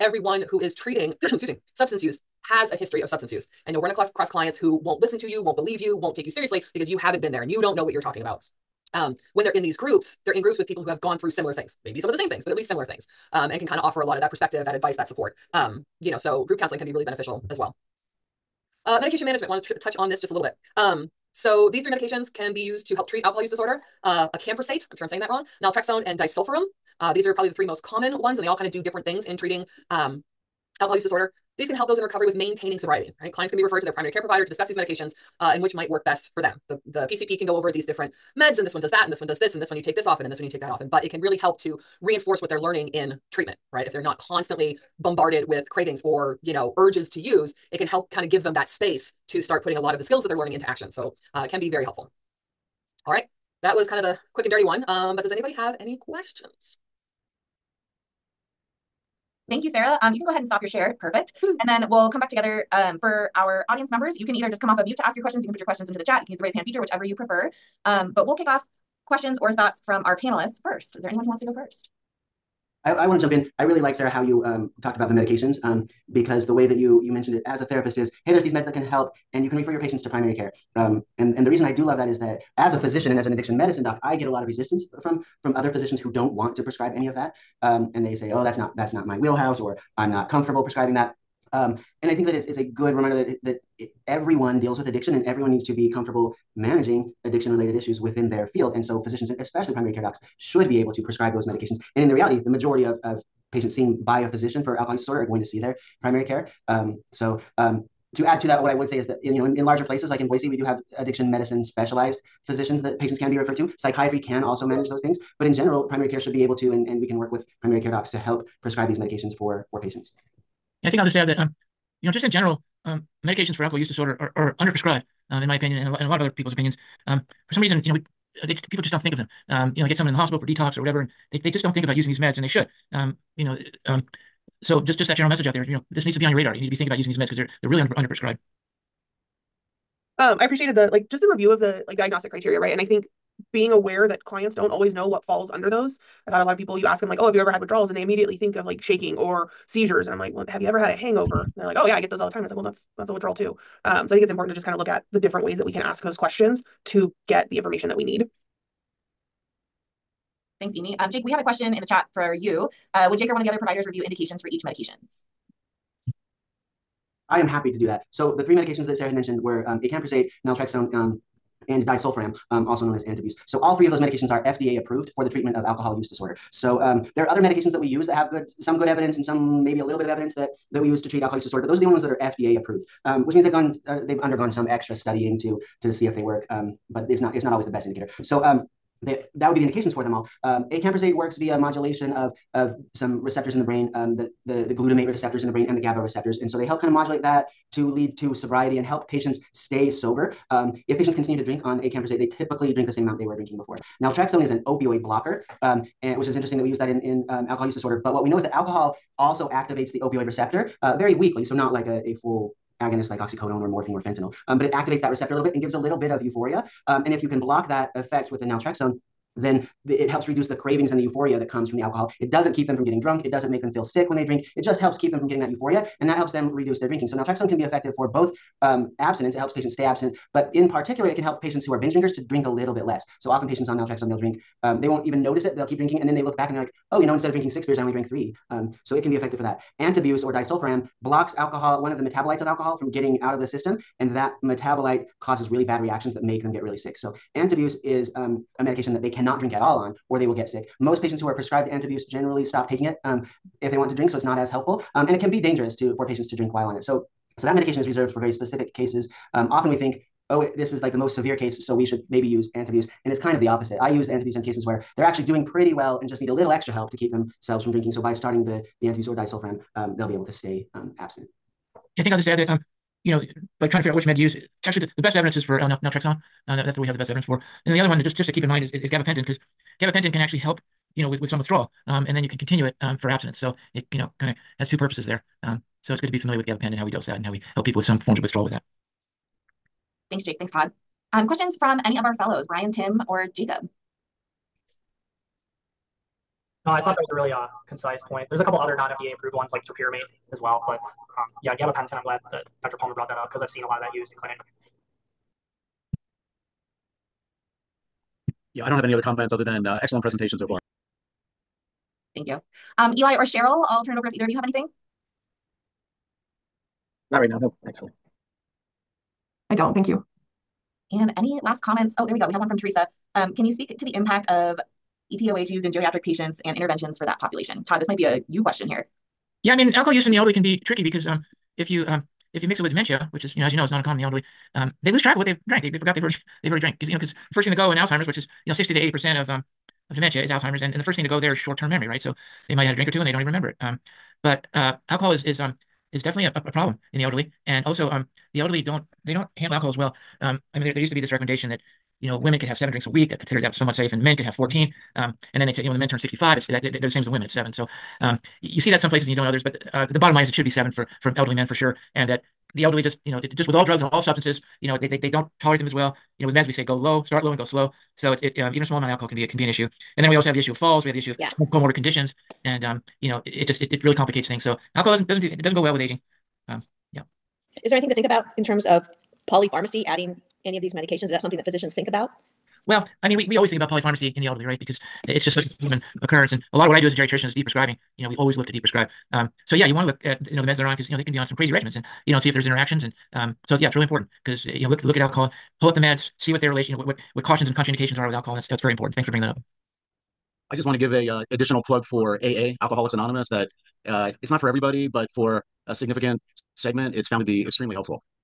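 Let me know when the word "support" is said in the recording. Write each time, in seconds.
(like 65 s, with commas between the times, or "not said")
15 s.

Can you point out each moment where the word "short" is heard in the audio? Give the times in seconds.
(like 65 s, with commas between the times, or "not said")
341 s.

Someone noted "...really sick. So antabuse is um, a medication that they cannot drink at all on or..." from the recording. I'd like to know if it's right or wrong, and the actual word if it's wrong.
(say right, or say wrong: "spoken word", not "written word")
right.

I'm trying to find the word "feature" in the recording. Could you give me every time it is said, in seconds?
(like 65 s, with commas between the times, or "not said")
66 s.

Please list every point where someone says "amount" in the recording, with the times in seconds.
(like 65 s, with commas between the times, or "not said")
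203 s, 368 s.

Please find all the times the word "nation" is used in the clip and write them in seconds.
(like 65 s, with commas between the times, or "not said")
not said.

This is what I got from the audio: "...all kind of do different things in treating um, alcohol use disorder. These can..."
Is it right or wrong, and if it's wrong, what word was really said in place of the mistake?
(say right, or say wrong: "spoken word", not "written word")
right.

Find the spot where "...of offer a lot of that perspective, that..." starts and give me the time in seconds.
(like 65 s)
13 s.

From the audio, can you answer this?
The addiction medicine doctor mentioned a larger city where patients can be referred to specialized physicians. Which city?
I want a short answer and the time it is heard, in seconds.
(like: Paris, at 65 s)
Boise, at 110 s.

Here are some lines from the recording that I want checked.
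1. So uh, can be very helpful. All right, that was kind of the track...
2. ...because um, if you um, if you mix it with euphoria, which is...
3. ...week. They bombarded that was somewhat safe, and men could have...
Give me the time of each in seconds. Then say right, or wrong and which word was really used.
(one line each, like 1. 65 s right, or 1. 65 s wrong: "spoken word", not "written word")
1. 50 s wrong: "quick", not "track"
2. 330 s wrong: "dementia", not "euphoria"
3. 352 s wrong: "considered", not "bombarded".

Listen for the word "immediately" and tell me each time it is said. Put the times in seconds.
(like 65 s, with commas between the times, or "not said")
148 s.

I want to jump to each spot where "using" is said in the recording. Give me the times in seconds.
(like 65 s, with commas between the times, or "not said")
131 s, 136 s.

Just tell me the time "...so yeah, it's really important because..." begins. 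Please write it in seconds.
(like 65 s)
393 s.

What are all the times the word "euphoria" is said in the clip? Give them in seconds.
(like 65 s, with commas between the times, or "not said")
216 s, 221 s, 225 s.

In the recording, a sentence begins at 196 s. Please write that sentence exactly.
And so they help kind of modulate that to lead to sobriety and help patients stay sober.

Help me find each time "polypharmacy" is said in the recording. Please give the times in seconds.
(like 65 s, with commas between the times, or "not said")
379 s, 383 s.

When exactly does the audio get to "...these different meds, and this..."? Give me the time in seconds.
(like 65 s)
37 s.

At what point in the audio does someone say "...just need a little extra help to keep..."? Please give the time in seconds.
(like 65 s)
266 s.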